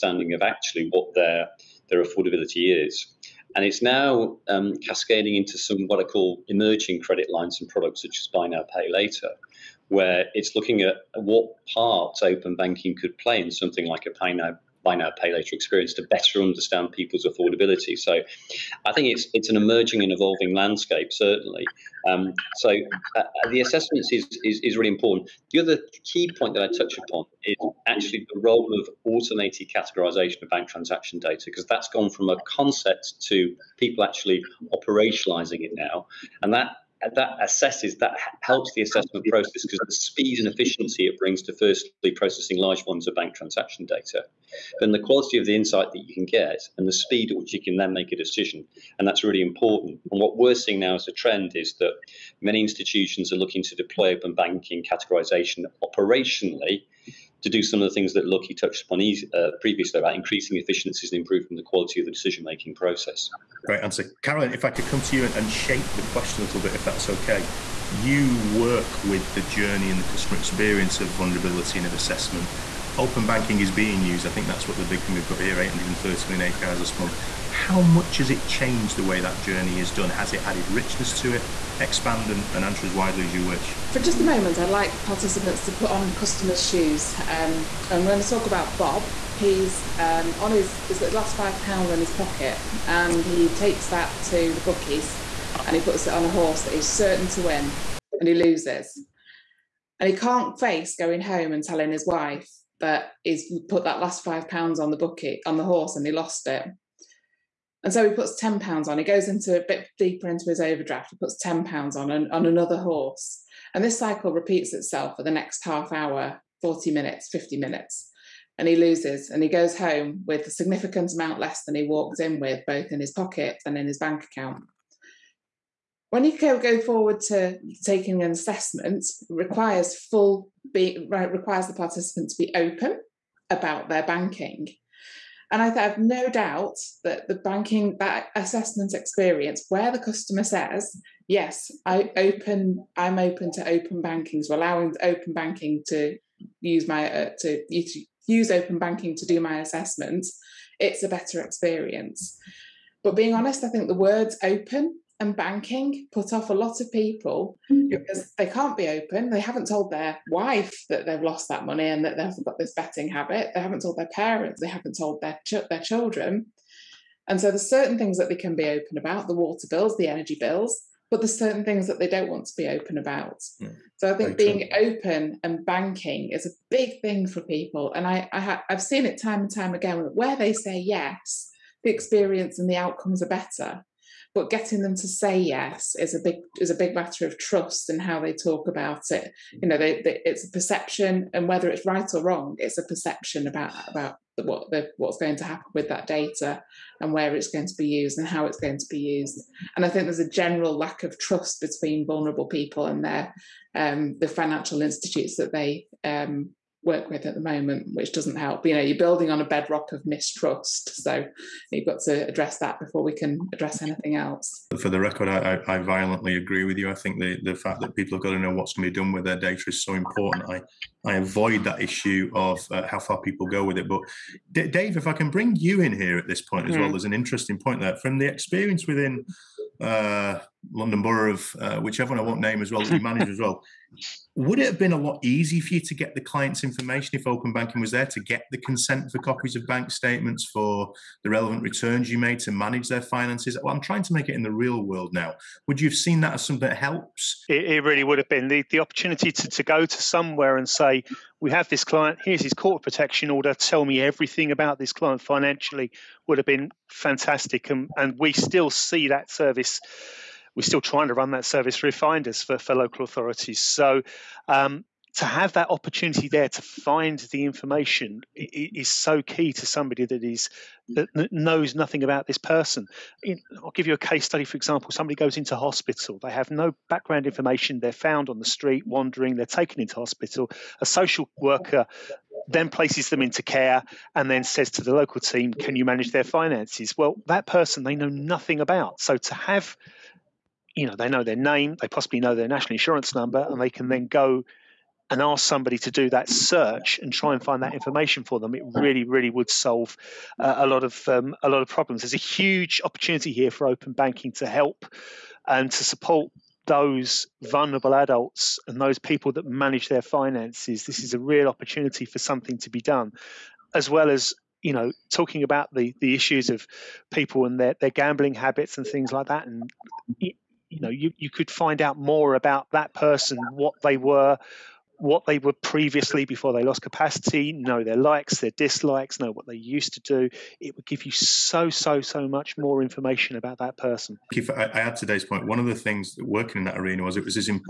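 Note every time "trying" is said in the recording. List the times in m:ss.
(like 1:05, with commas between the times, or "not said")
4:03, 4:20.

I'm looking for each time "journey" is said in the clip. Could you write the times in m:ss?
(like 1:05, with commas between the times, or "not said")
1:09, 1:19.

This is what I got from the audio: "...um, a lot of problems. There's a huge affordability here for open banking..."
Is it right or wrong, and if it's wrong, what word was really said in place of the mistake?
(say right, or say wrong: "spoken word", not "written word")
wrong: "opportunity", not "affordability".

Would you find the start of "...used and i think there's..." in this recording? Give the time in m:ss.
3:18.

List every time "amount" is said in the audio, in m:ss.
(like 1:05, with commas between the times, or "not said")
2:01.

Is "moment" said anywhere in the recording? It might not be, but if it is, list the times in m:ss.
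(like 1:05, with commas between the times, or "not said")
1:24, 3:27.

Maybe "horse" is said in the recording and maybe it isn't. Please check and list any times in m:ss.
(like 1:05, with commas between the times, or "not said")
1:36, 1:45, 1:52.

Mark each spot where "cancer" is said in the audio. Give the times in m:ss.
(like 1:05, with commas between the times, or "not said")
not said.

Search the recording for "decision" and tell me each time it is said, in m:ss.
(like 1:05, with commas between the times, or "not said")
0:48, 1:02.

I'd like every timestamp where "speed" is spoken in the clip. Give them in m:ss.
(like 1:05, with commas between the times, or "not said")
0:39, 0:46.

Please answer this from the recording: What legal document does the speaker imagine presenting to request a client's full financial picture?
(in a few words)
court protection order.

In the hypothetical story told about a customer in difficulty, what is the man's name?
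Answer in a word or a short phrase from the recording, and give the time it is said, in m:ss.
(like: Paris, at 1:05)
Bob, at 1:28.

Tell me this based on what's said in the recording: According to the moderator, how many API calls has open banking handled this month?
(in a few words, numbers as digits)
830 million.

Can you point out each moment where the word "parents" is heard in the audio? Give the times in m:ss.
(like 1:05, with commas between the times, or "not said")
2:44.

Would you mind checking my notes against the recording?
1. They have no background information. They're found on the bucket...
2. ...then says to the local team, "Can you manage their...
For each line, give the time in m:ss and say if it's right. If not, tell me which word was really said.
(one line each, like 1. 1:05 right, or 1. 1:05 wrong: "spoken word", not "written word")
1. 4:36 wrong: "street", not "bucket"
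2. 4:44 right.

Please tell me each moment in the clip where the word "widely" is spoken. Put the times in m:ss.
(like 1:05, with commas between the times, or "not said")
1:22.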